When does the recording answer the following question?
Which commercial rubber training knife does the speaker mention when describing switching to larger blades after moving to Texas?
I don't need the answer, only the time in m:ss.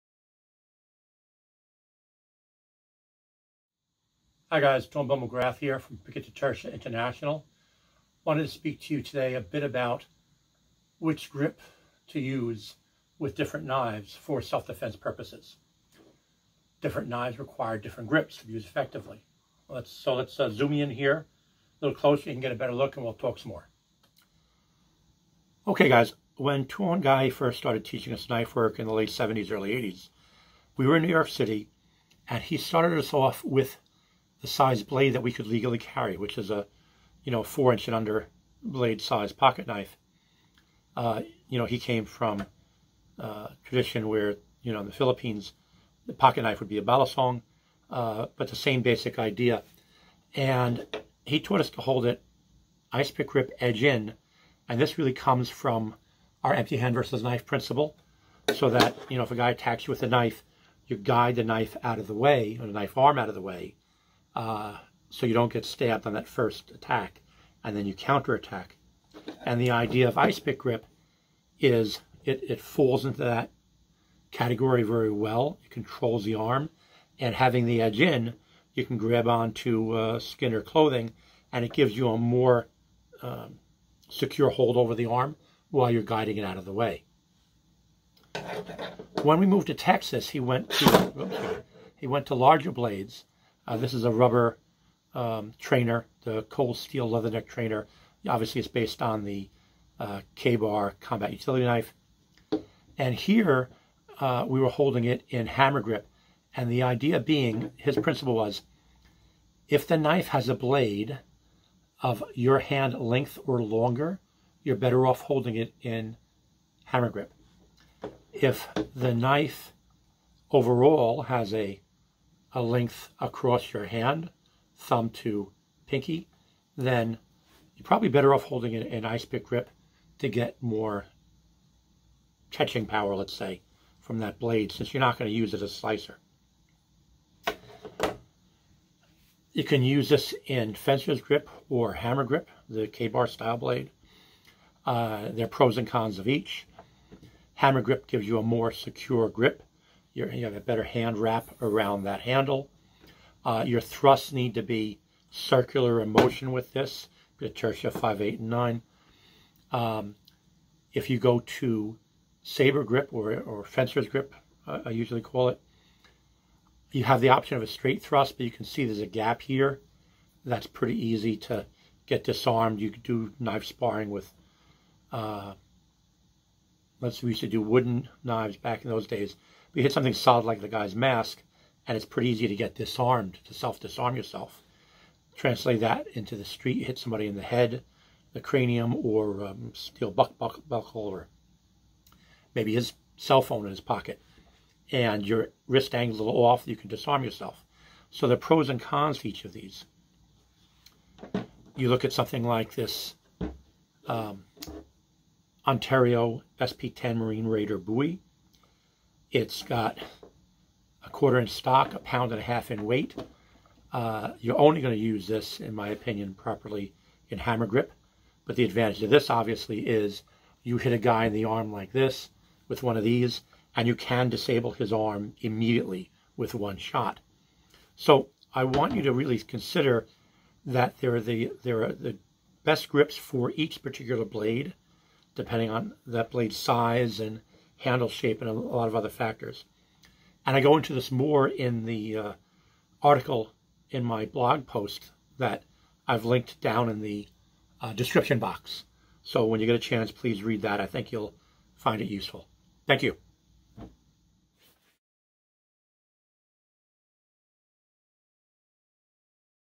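1:36.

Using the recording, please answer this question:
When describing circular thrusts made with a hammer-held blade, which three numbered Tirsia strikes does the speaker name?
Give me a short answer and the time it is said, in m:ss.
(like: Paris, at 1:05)
5, 8, and 9, at 2:37.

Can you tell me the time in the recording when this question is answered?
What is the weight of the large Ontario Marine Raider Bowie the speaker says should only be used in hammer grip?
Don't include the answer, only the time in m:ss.
3:31.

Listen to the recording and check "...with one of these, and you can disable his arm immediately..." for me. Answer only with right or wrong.
right.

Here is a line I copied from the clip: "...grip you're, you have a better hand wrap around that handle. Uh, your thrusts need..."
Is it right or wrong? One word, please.
right.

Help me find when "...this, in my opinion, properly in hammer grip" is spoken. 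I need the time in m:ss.
3:35.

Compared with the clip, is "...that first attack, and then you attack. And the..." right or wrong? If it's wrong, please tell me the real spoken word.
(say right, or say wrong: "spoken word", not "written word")
wrong: "counterattack", not "attack".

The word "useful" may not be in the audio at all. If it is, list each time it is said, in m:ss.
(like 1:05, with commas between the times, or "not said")
4:12.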